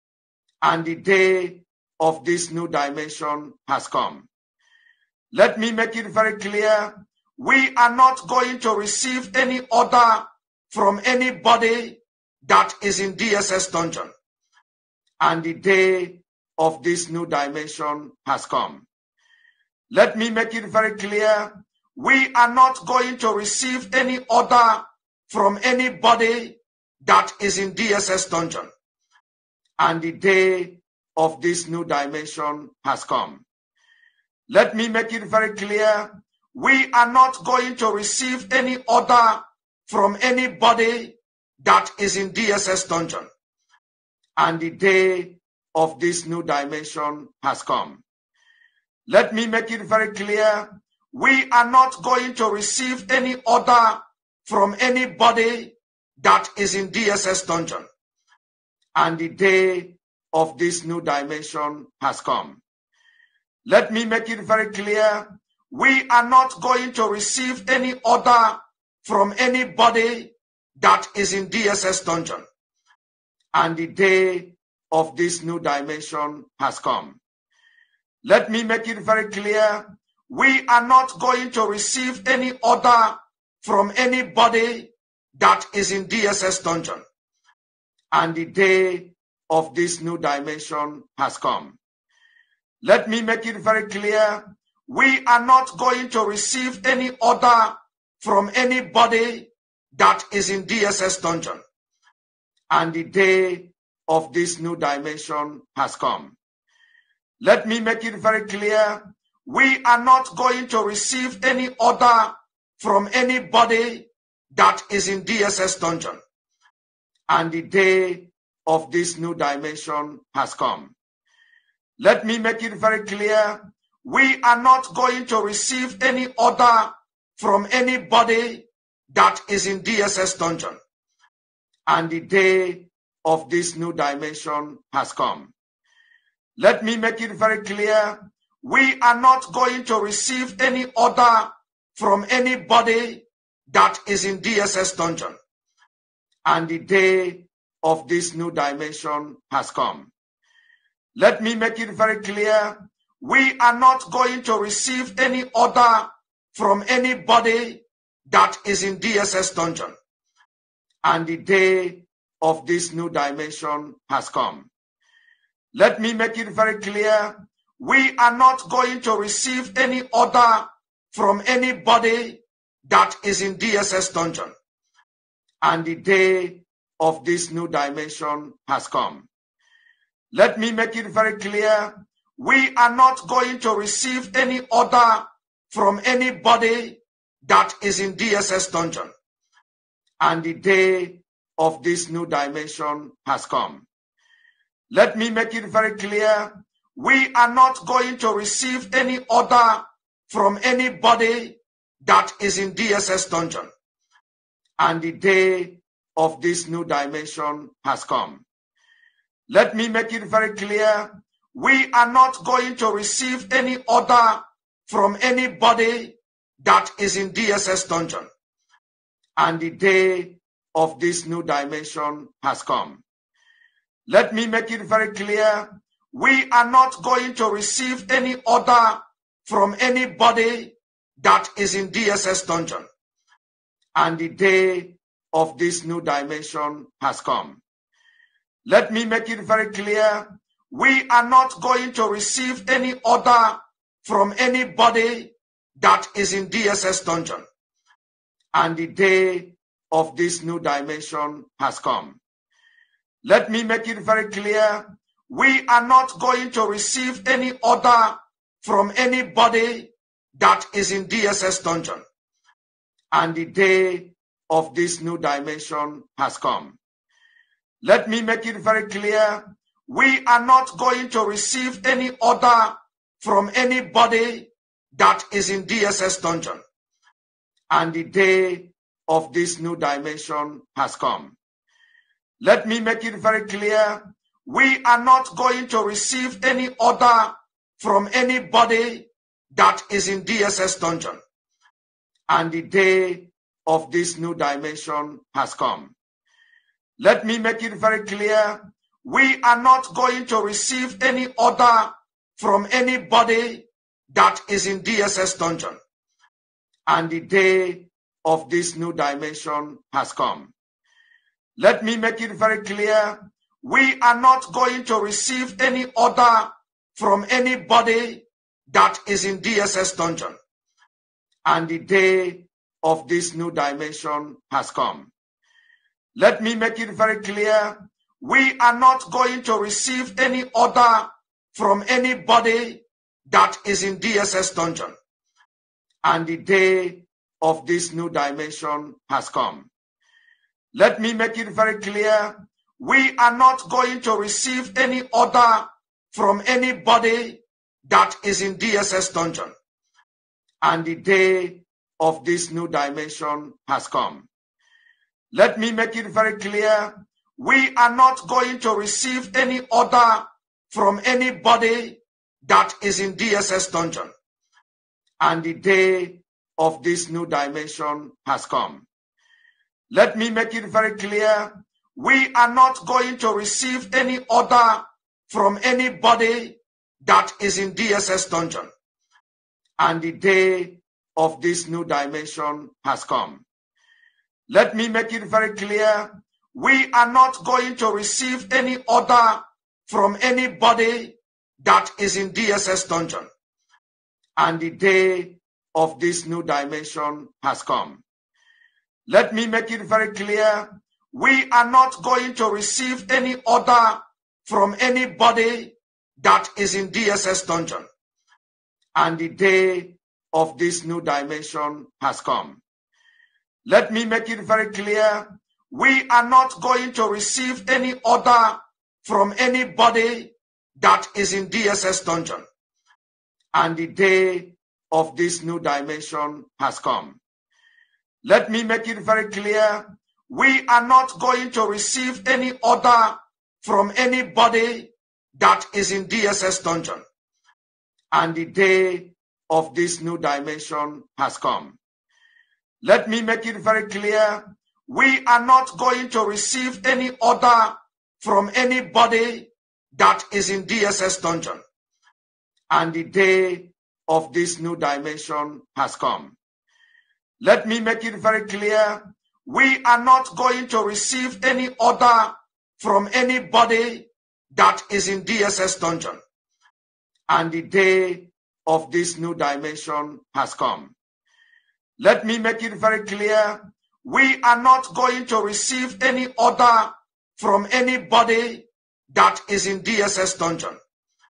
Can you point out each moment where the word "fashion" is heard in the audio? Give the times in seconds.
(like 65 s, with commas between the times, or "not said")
not said.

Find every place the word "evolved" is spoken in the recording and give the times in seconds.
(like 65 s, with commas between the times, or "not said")
not said.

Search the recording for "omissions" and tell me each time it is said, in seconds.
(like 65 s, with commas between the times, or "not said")
not said.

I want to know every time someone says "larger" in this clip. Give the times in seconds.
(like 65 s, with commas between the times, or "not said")
not said.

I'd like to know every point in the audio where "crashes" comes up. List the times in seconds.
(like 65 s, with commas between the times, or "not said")
not said.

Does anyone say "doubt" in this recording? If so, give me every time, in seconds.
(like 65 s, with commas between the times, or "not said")
not said.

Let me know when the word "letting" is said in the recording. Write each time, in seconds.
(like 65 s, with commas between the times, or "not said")
not said.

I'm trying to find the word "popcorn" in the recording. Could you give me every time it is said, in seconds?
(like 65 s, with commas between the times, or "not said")
not said.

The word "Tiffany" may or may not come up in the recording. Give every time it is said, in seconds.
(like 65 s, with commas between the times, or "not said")
not said.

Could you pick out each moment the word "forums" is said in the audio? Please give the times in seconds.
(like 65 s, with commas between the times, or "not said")
not said.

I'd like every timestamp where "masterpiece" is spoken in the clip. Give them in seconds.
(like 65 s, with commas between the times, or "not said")
not said.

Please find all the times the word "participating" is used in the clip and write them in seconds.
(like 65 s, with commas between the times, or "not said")
not said.